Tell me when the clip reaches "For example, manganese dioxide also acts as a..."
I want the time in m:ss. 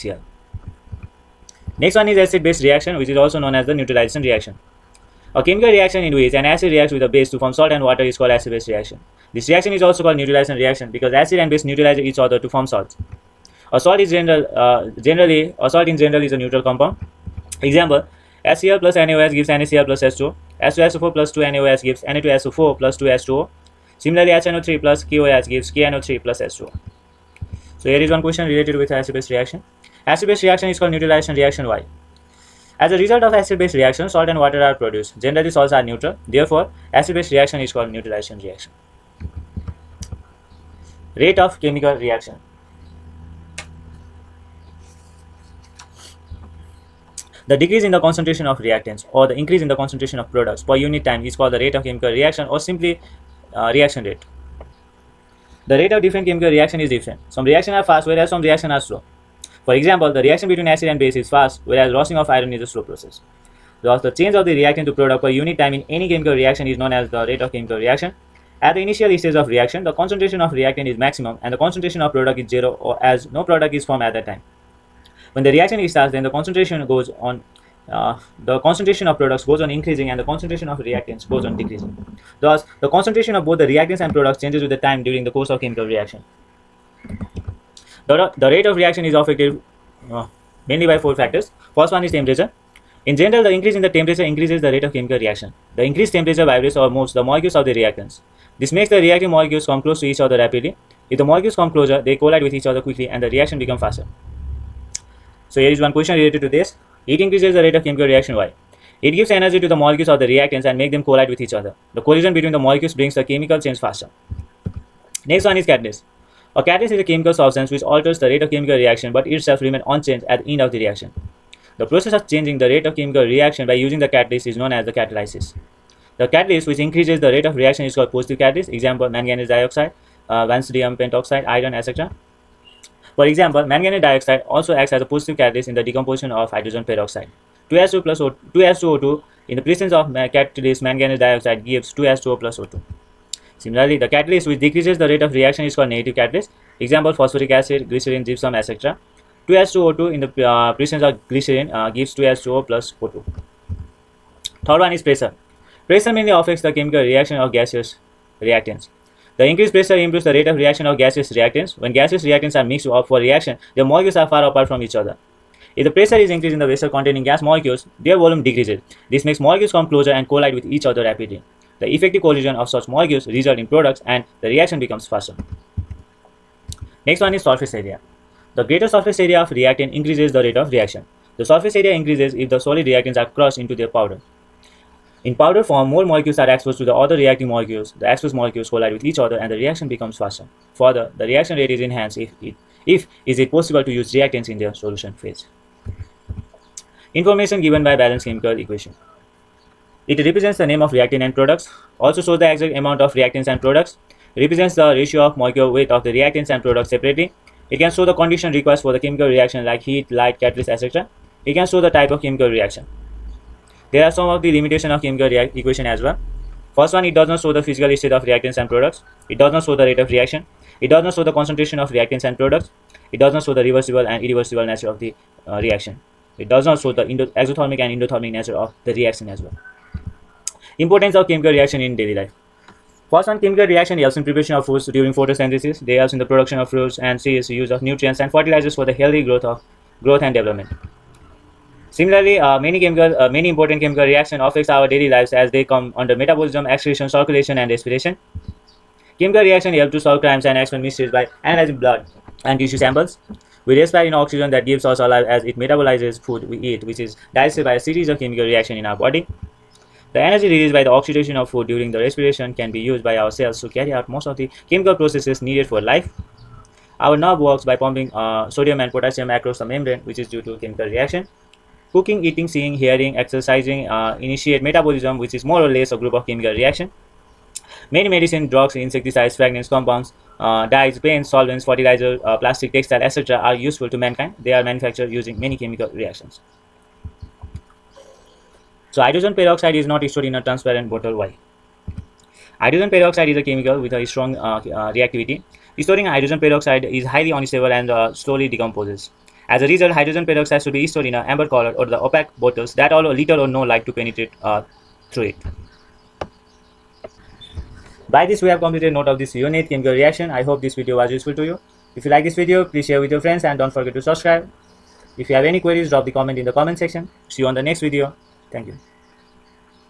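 2:13.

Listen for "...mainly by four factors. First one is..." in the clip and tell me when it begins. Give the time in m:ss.
1:30.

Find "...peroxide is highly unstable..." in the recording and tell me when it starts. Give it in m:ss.
4:56.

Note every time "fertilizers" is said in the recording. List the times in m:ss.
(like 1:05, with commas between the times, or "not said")
3:58, 4:41.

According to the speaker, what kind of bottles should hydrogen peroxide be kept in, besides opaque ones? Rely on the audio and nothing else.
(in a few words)
amber color.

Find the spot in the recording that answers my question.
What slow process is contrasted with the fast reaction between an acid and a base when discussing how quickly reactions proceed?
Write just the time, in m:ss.
1:01.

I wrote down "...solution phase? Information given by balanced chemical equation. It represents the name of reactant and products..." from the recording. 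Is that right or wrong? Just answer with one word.
right.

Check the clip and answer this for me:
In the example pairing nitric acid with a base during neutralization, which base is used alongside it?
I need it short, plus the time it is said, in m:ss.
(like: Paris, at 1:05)
KOH, at 0:25.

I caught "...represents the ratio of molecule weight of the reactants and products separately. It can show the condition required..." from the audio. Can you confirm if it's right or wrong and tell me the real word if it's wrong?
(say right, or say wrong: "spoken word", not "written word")
right.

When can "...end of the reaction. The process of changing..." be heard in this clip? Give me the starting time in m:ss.
2:00.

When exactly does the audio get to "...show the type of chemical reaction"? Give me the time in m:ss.
3:31.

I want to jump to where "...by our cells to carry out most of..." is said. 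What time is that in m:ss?
4:23.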